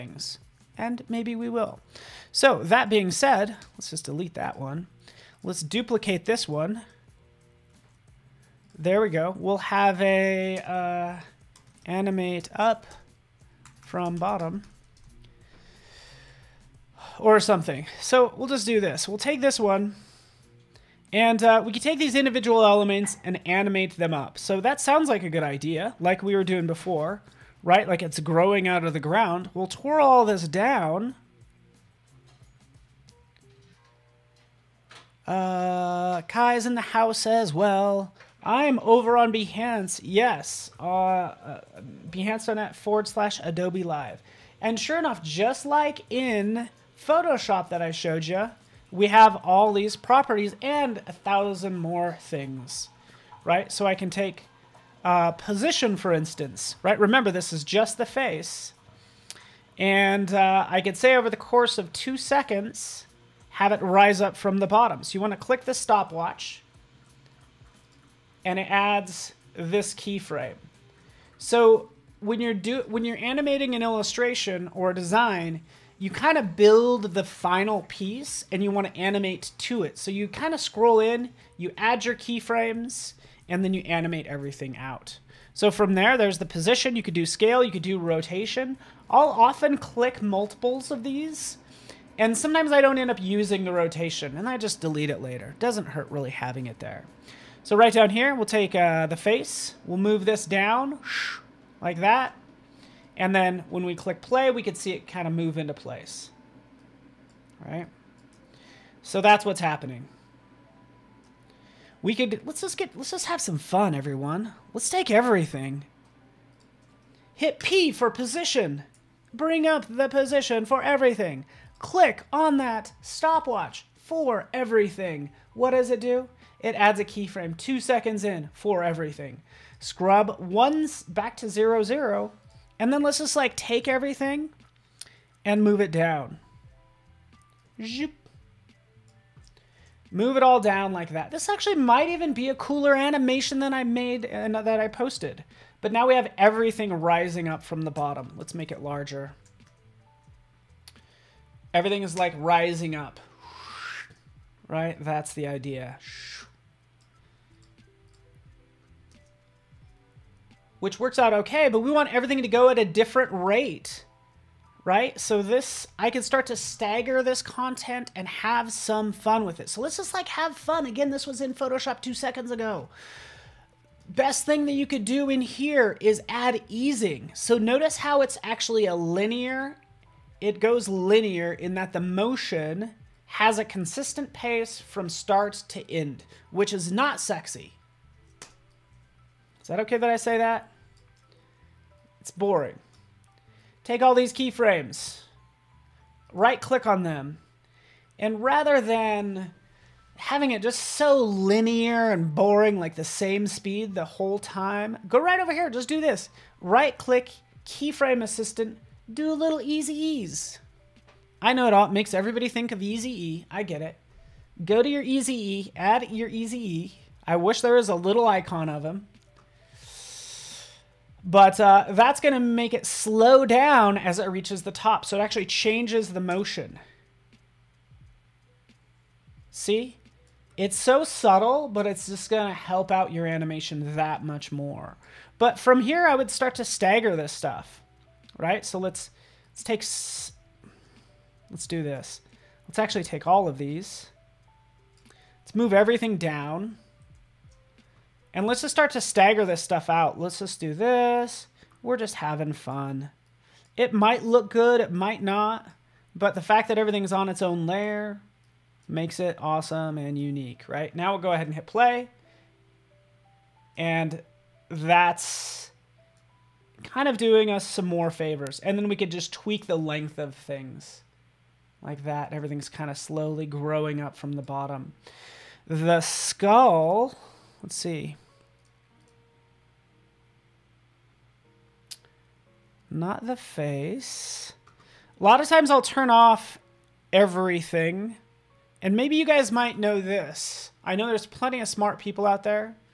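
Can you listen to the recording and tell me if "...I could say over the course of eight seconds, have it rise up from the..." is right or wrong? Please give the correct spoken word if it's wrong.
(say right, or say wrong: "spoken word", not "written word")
wrong: "two", not "eight".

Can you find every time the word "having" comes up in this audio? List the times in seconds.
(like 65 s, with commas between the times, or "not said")
96 s, 200 s, 252 s.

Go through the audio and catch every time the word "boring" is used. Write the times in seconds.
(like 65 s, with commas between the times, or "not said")
192 s, 202 s.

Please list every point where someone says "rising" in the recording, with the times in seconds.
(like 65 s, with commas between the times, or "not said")
146 s, 152 s.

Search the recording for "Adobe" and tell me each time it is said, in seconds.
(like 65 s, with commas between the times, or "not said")
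43 s.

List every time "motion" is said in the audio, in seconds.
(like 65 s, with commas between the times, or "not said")
181 s, 226 s.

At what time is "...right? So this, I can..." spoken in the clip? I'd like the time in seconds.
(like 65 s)
164 s.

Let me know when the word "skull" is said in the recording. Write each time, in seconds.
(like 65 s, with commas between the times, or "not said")
276 s.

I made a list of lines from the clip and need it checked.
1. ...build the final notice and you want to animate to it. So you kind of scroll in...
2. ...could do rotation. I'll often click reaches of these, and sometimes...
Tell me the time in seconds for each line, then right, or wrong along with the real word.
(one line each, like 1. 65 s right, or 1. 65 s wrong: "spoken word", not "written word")
1. 76 s wrong: "piece", not "notice"
2. 87 s wrong: "multiples", not "reaches".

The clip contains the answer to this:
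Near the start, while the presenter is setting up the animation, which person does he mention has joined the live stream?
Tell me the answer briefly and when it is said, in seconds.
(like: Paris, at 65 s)
Kai, at 36 s.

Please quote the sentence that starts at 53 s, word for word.
So I can take uh, position, for instance, right?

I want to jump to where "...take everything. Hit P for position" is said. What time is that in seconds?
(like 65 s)
114 s.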